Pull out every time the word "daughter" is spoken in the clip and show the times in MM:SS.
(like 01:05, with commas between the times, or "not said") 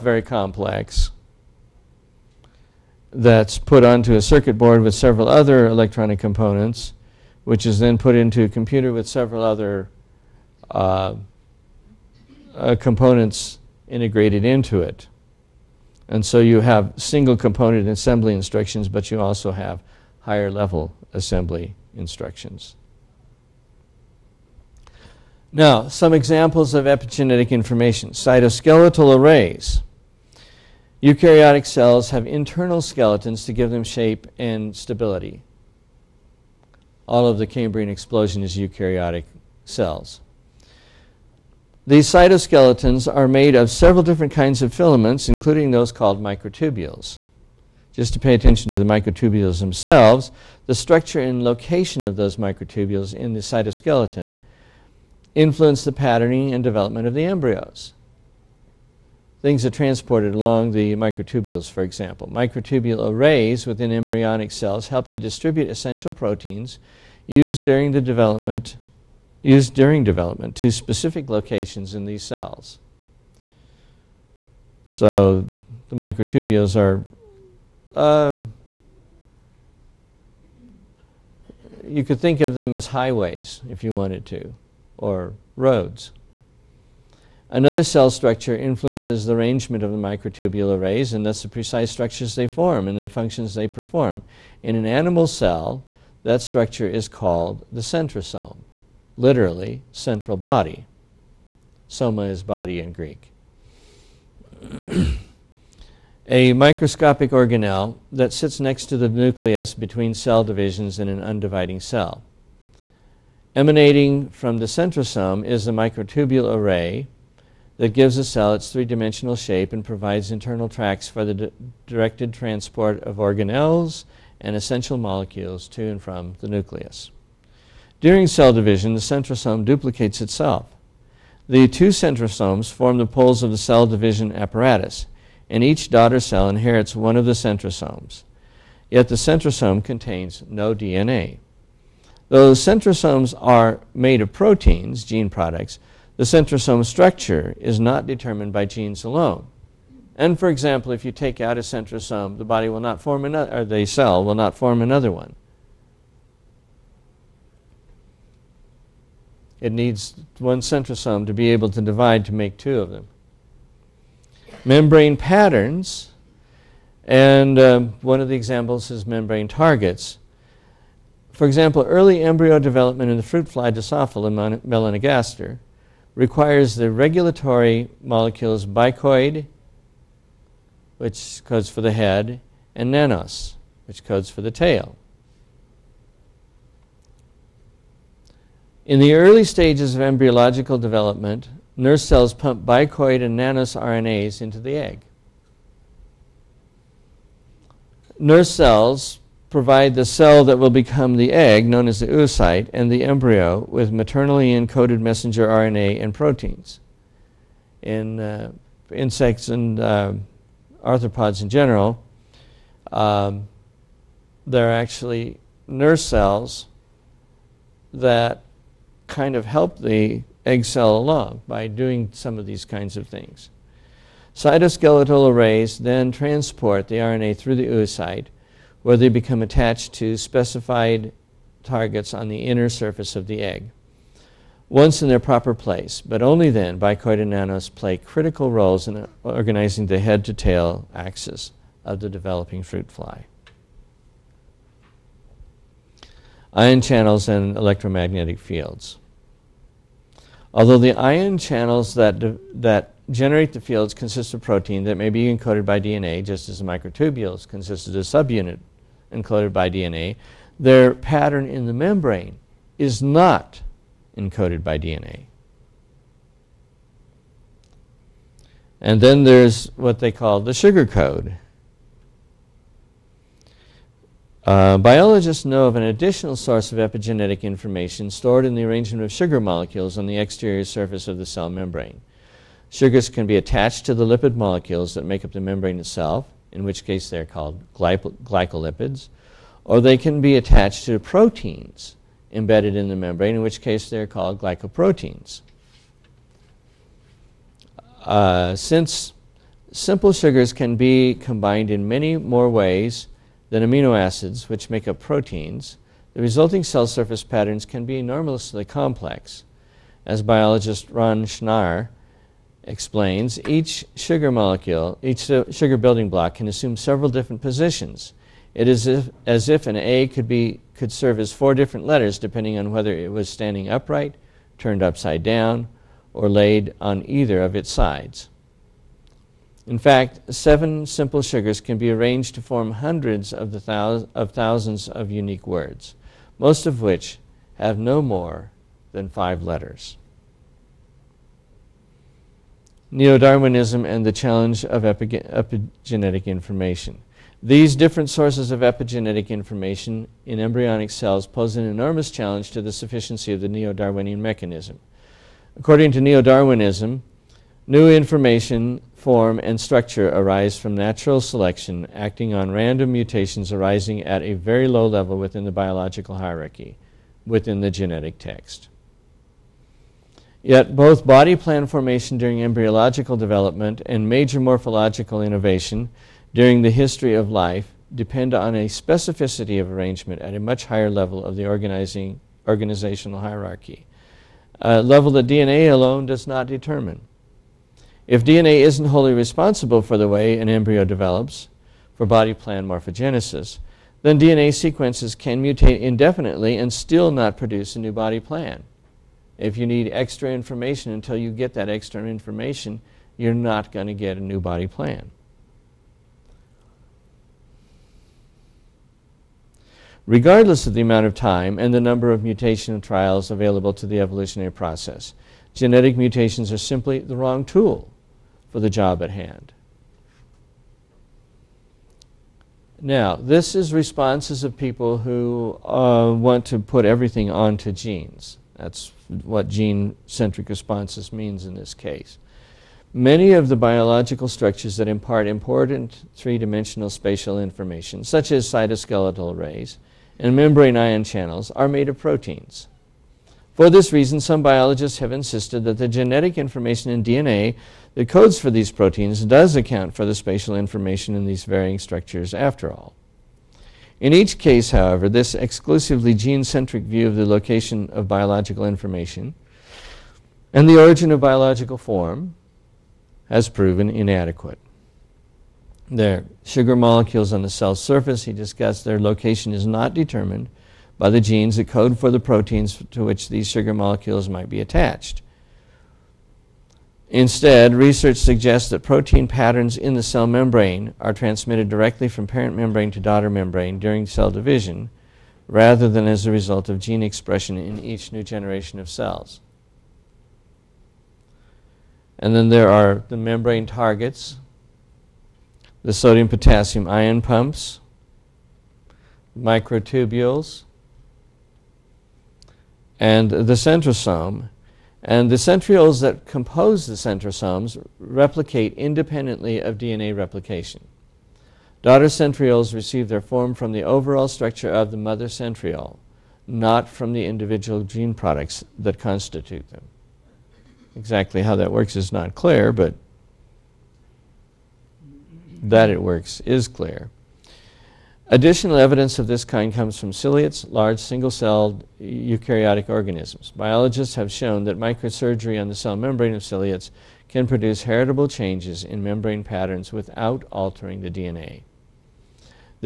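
02:15, 08:02, 08:31.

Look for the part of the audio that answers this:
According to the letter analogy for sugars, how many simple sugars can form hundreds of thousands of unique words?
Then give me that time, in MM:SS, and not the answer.
05:30.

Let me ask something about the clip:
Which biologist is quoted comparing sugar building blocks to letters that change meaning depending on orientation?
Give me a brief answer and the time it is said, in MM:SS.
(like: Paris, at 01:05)
Ron Schnaar, at 05:10.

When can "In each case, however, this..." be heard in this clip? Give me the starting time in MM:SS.
07:34.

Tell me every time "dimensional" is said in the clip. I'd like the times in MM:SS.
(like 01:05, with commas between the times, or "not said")
01:58, 07:16.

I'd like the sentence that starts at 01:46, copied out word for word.
a microscopic organelle that sits next to the nucleus between cell divisions in an undividing cell.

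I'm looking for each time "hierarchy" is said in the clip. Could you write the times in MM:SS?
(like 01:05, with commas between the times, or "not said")
06:06, 06:23.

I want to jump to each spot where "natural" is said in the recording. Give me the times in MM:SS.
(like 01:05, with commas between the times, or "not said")
06:00.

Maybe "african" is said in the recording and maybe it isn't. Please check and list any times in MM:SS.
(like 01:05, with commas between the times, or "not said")
not said.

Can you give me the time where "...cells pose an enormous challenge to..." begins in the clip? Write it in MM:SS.
05:50.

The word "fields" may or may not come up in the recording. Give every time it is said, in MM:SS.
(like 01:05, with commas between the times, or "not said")
04:08, 04:13.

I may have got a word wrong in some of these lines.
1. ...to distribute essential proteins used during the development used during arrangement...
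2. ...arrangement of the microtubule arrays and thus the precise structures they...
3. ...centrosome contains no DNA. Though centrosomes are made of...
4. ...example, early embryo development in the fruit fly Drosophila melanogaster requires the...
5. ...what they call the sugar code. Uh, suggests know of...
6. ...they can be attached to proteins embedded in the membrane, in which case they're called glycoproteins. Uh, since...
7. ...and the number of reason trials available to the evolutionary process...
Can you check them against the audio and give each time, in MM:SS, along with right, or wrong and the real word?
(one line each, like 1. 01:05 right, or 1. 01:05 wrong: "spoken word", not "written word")
1. 01:05 wrong: "development", not "arrangement"
2. 01:29 right
3. 02:19 right
4. 02:51 right
5. 04:29 wrong: "biologists", not "suggests"
6. 04:49 right
7. 06:51 wrong: "mutation", not "reason".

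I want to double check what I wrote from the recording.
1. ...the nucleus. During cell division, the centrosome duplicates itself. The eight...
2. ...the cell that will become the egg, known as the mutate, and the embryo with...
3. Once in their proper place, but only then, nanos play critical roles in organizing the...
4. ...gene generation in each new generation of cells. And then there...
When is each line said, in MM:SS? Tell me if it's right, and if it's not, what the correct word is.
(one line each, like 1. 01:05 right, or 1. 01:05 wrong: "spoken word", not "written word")
1. 02:06 wrong: "two", not "eight"
2. 03:19 wrong: "oocyte", not "mutate"
3. 03:54 right
4. 08:06 wrong: "expression", not "generation".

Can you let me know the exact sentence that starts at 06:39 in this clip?
If you need extra information until you get that extra information, you're not going to get a new body plan.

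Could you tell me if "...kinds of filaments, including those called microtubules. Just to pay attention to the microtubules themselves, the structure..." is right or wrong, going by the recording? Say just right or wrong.
right.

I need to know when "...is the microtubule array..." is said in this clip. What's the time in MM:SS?
01:55.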